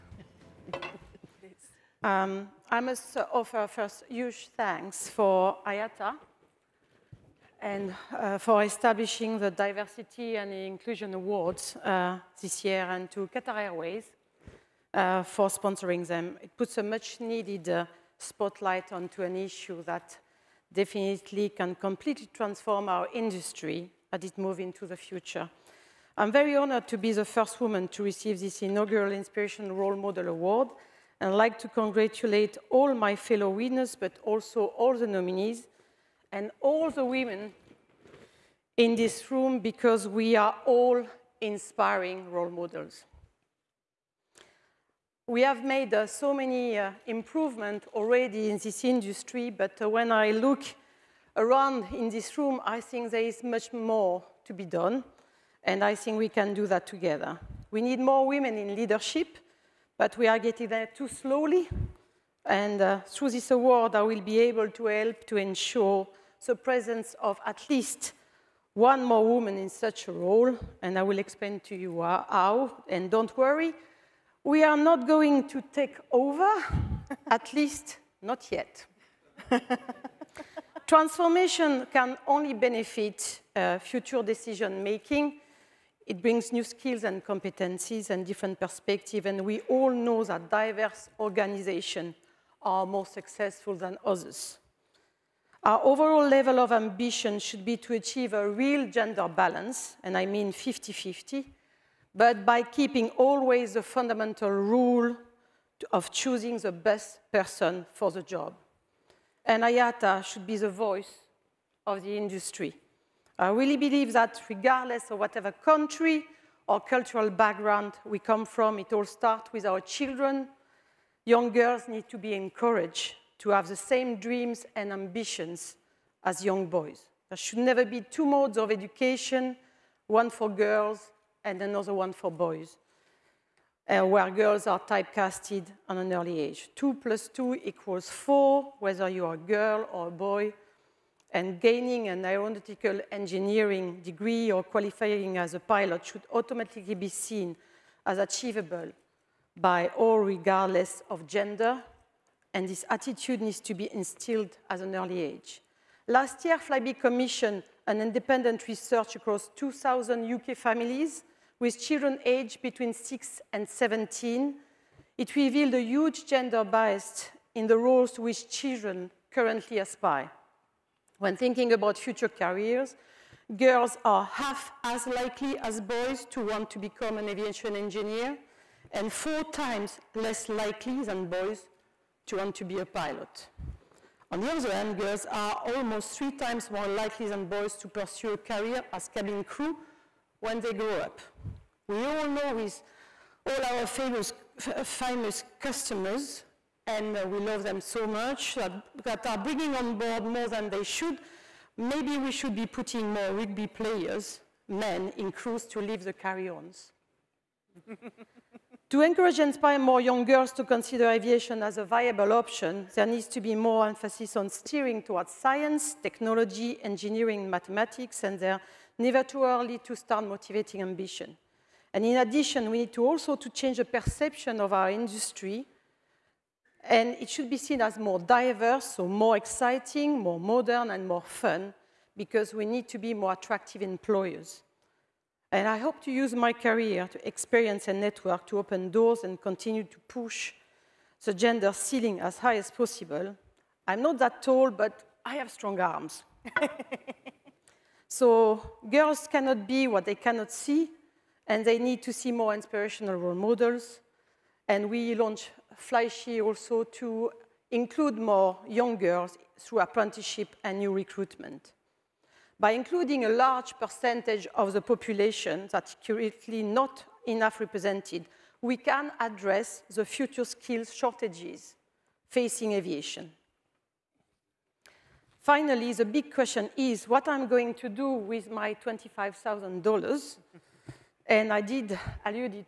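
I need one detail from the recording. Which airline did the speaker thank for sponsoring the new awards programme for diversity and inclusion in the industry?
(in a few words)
Qatar Airways.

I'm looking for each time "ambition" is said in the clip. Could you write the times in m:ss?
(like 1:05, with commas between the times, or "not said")
1:36, 2:04, 3:40.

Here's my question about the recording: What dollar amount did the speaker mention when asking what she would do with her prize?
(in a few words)
$25,000.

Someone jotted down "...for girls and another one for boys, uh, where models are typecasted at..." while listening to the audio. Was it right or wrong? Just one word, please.
wrong.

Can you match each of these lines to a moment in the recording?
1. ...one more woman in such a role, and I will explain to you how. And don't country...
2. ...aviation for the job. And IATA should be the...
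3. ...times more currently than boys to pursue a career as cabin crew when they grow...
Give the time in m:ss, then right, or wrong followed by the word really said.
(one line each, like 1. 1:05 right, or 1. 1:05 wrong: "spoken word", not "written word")
1. 1:08 wrong: "worry", not "country"
2. 1:47 wrong: "person", not "aviation"
3. 3:06 wrong: "likely", not "currently".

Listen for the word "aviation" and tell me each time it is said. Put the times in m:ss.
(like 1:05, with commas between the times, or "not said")
2:57, 3:31, 4:32.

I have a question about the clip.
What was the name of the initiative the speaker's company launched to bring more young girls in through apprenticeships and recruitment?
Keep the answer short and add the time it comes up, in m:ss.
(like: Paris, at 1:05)
FlyShe, at 4:15.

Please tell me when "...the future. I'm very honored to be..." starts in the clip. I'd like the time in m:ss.
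0:24.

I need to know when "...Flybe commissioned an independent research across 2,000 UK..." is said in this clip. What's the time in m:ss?
2:36.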